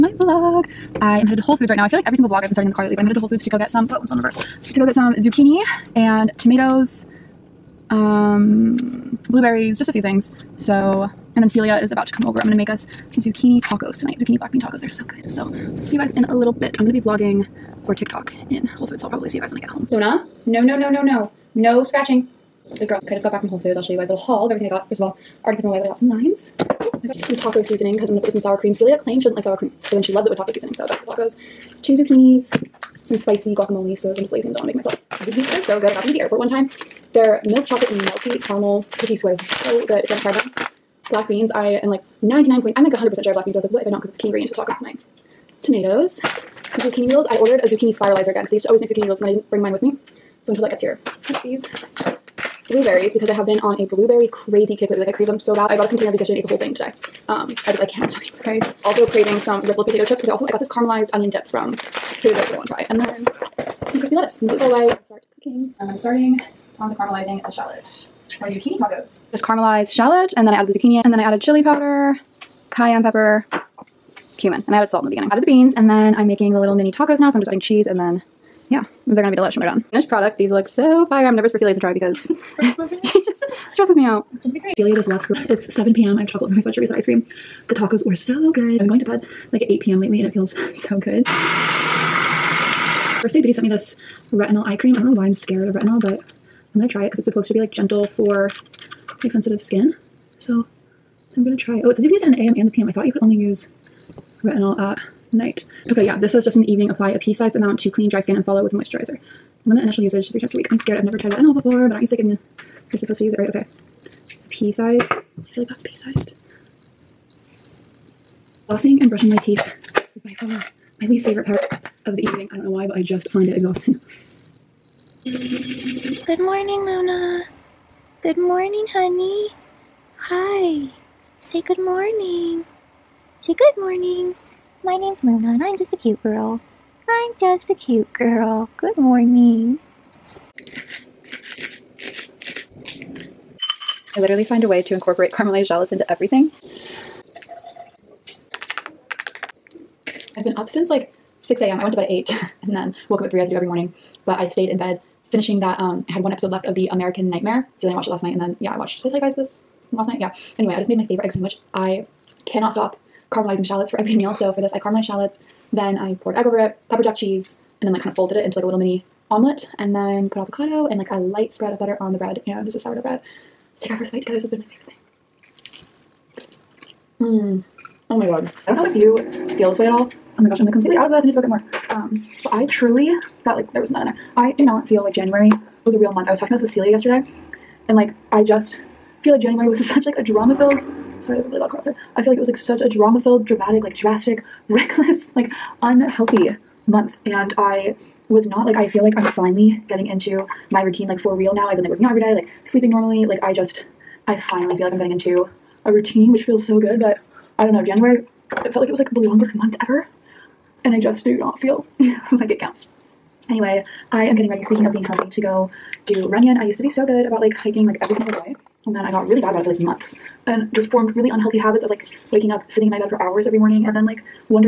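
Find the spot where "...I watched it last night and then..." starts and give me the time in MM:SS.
02:37.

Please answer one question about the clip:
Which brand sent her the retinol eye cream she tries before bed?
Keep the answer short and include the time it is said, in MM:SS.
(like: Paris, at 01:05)
First Aid Beauty, at 01:31.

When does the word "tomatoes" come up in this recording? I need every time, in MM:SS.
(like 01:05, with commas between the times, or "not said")
00:06, 00:45.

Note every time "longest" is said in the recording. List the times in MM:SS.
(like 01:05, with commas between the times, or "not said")
03:29.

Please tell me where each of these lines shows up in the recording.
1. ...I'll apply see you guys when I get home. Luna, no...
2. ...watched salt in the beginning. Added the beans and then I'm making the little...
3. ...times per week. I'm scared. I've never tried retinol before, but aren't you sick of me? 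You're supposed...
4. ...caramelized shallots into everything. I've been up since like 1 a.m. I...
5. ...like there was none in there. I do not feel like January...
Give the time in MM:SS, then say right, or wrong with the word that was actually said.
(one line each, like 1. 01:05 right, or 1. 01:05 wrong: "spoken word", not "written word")
1. 00:19 wrong: "probably", not "apply"
2. 01:14 wrong: "added", not "watched"
3. 01:50 right
4. 02:25 wrong: "6", not "1"
5. 03:03 right.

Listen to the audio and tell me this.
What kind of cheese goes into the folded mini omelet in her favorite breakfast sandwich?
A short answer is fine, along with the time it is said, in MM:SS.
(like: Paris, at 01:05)
pepper jack, at 02:46.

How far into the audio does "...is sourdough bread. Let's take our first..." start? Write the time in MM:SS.
02:52.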